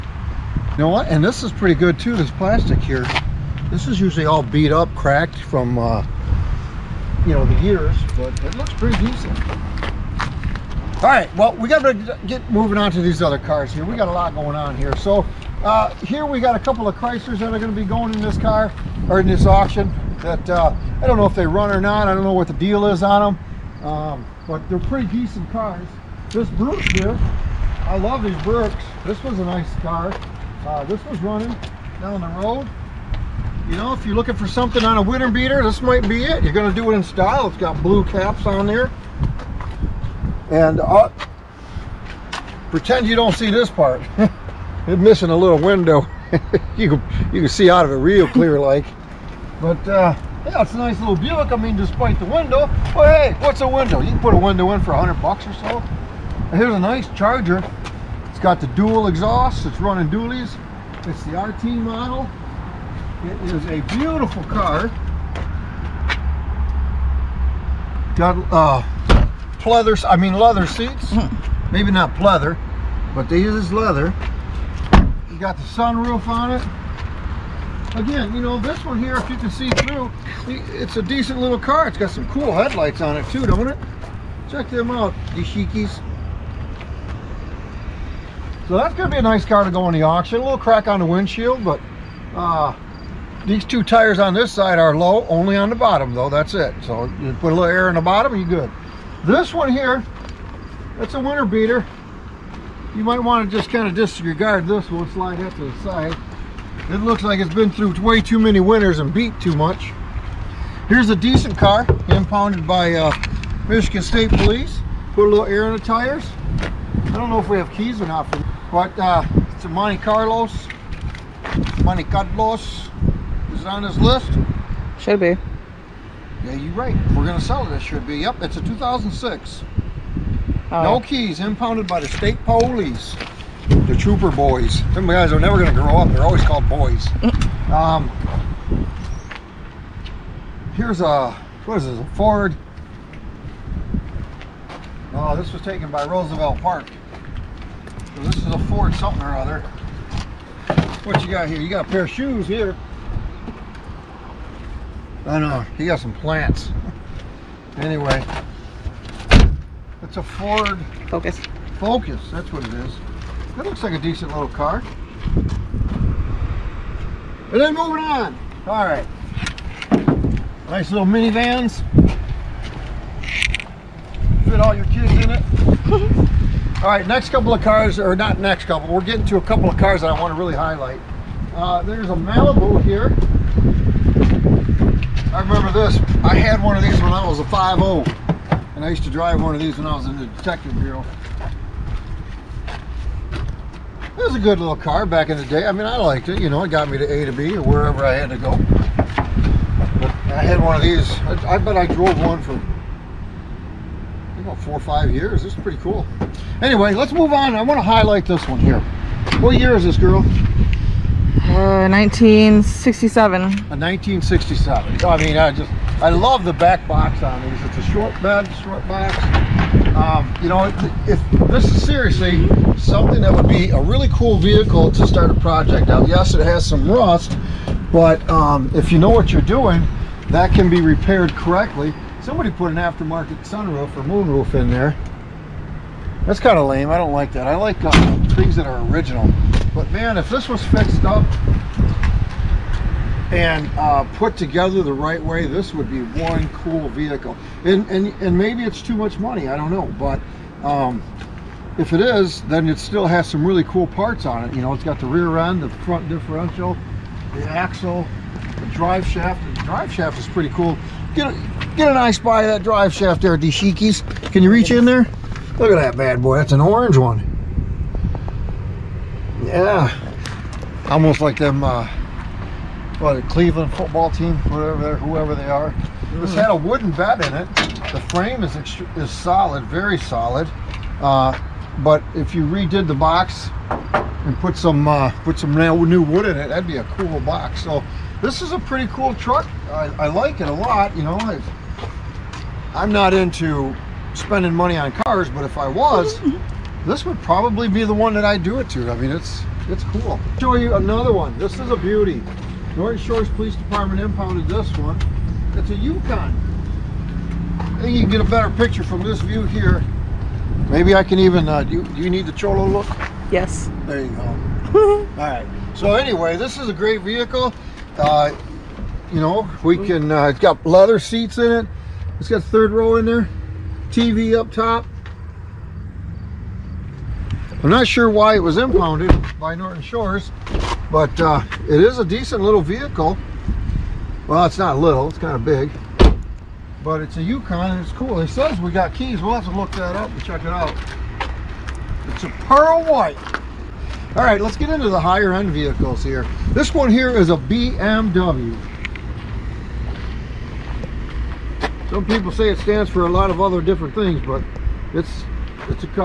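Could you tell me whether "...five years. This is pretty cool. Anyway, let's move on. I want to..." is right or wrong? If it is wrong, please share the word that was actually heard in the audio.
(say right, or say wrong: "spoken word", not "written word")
right.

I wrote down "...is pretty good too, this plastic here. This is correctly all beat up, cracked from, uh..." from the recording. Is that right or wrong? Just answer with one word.
wrong.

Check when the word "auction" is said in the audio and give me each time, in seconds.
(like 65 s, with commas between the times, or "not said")
19 s, 90 s.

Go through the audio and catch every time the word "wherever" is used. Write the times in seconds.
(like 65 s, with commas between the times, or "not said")
197 s.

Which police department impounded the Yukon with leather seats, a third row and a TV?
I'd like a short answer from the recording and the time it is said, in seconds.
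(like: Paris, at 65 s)
Norton Shores Police Department, at 302 s.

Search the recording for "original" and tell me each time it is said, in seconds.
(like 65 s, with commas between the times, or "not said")
238 s.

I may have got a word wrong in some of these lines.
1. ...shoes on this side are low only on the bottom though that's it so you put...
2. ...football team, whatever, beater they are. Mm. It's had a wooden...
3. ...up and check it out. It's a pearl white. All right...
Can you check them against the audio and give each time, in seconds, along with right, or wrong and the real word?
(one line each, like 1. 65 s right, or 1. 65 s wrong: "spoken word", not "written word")
1. 93 s wrong: "tires", not "shoes"
2. 273 s wrong: "whoever", not "beater"
3. 339 s right.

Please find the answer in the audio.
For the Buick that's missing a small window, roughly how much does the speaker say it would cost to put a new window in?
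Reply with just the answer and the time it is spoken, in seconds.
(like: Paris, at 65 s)
$100, at 54 s.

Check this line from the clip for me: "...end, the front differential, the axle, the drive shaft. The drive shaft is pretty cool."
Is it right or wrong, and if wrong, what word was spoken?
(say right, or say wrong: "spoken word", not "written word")
right.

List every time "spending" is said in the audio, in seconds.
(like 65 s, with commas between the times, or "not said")
294 s.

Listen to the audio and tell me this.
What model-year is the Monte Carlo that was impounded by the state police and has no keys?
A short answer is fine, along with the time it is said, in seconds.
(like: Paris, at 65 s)
2006, at 128 s.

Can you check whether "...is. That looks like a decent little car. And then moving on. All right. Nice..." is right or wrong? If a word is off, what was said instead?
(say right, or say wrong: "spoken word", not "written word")
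right.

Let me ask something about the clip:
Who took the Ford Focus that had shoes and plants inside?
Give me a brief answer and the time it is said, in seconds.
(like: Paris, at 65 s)
Roosevelt Park, at 146 s.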